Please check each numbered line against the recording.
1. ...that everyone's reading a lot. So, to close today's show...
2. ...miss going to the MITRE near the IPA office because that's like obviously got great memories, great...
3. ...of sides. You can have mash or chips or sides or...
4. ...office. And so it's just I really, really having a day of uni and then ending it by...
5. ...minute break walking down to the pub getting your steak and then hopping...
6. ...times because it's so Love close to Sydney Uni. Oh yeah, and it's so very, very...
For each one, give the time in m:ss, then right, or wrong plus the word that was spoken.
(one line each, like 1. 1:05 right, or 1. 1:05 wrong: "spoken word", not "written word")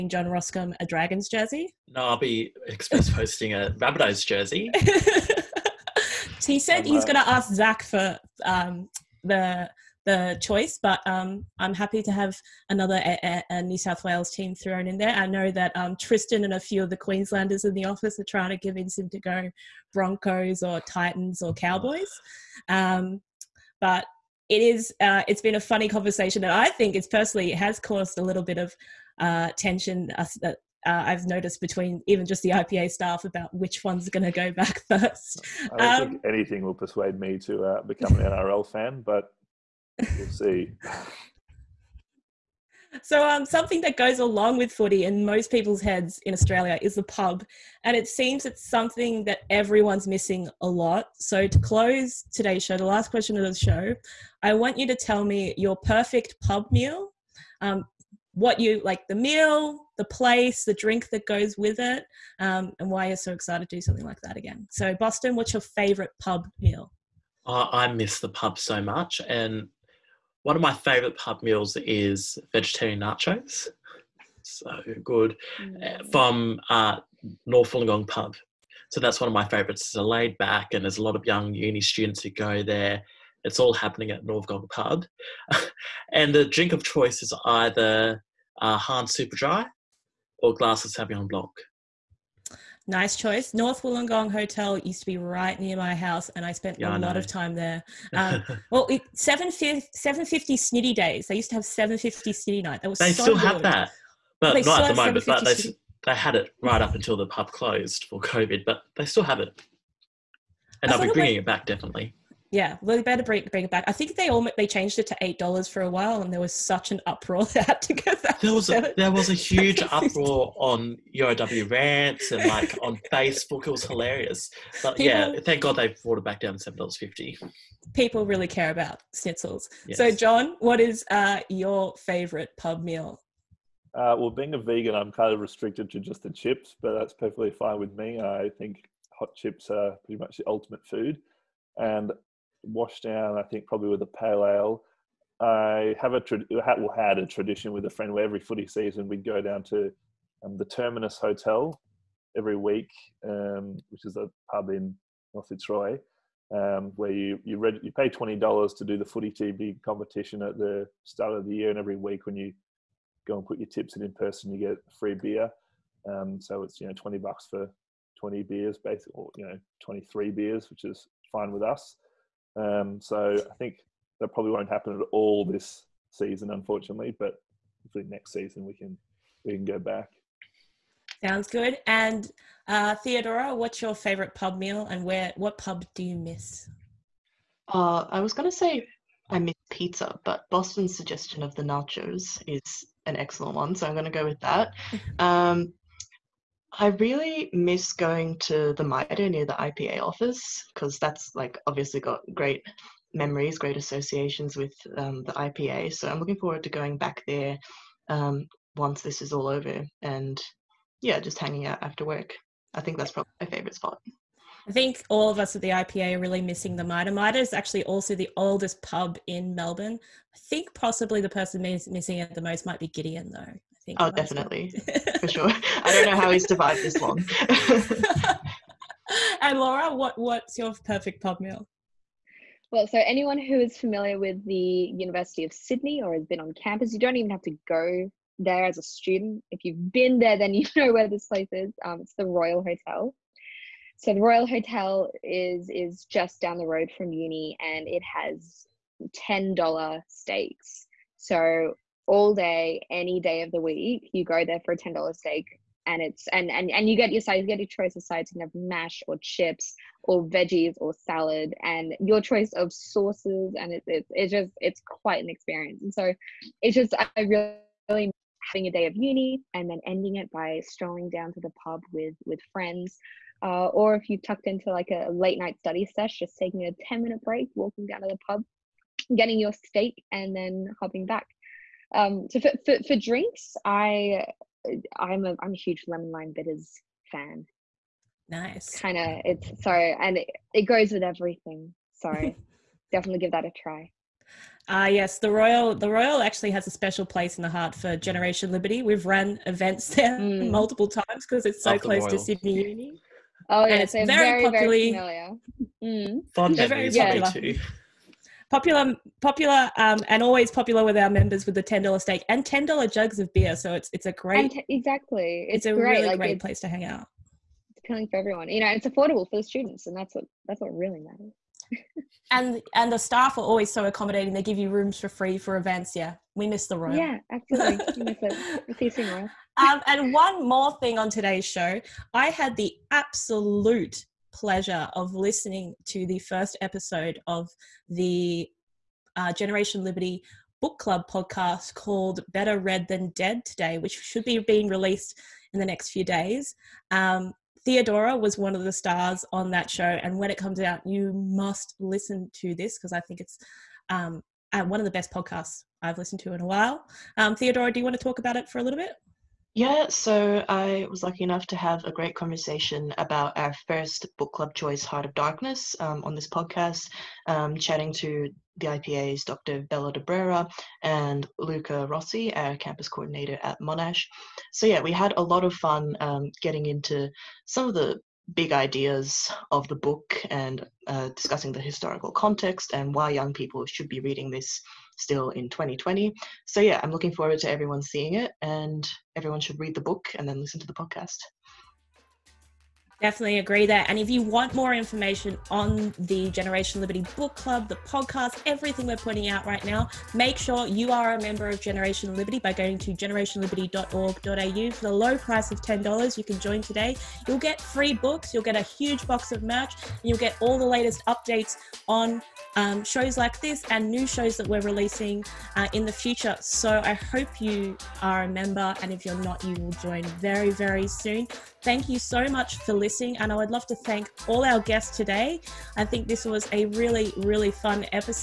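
1. 0:49 wrong: "missing", not "reading"
2. 3:17 right
3. 4:17 wrong: "veggies", not "sides"
4. 4:25 wrong: "experience", not "office"
5. 4:37 right
6. 5:00 right.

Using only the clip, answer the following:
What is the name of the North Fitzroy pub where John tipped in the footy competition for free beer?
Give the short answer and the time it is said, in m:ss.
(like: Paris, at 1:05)
Terminus Hotel, at 2:30.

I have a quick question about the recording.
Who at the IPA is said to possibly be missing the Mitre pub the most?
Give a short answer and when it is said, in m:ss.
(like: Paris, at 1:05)
Gideon, at 3:42.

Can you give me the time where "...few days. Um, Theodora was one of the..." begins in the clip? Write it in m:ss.
5:45.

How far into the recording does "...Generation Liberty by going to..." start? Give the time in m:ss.
6:41.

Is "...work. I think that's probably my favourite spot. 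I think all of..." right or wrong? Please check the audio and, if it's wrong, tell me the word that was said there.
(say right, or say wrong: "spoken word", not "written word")
right.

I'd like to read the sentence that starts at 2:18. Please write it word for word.
I think hot chips are pretty much the ultimate food.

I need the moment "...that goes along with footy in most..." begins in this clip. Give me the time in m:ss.
0:43.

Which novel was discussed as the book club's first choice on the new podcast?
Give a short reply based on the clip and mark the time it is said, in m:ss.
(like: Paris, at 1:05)
Heart of Darkness, at 6:04.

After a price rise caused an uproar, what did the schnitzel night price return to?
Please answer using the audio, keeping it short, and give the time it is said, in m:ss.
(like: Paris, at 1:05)
$7.50, at 2:06.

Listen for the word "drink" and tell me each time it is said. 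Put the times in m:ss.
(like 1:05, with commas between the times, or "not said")
1:00, 1:26, 4:42.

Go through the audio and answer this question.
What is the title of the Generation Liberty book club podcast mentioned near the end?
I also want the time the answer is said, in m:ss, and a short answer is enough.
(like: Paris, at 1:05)
Better Read Than Dead, at 5:42.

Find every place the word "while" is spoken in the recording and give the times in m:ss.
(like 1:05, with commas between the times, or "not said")
1:55, 5:56.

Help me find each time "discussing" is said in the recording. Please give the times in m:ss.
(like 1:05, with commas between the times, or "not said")
6:21.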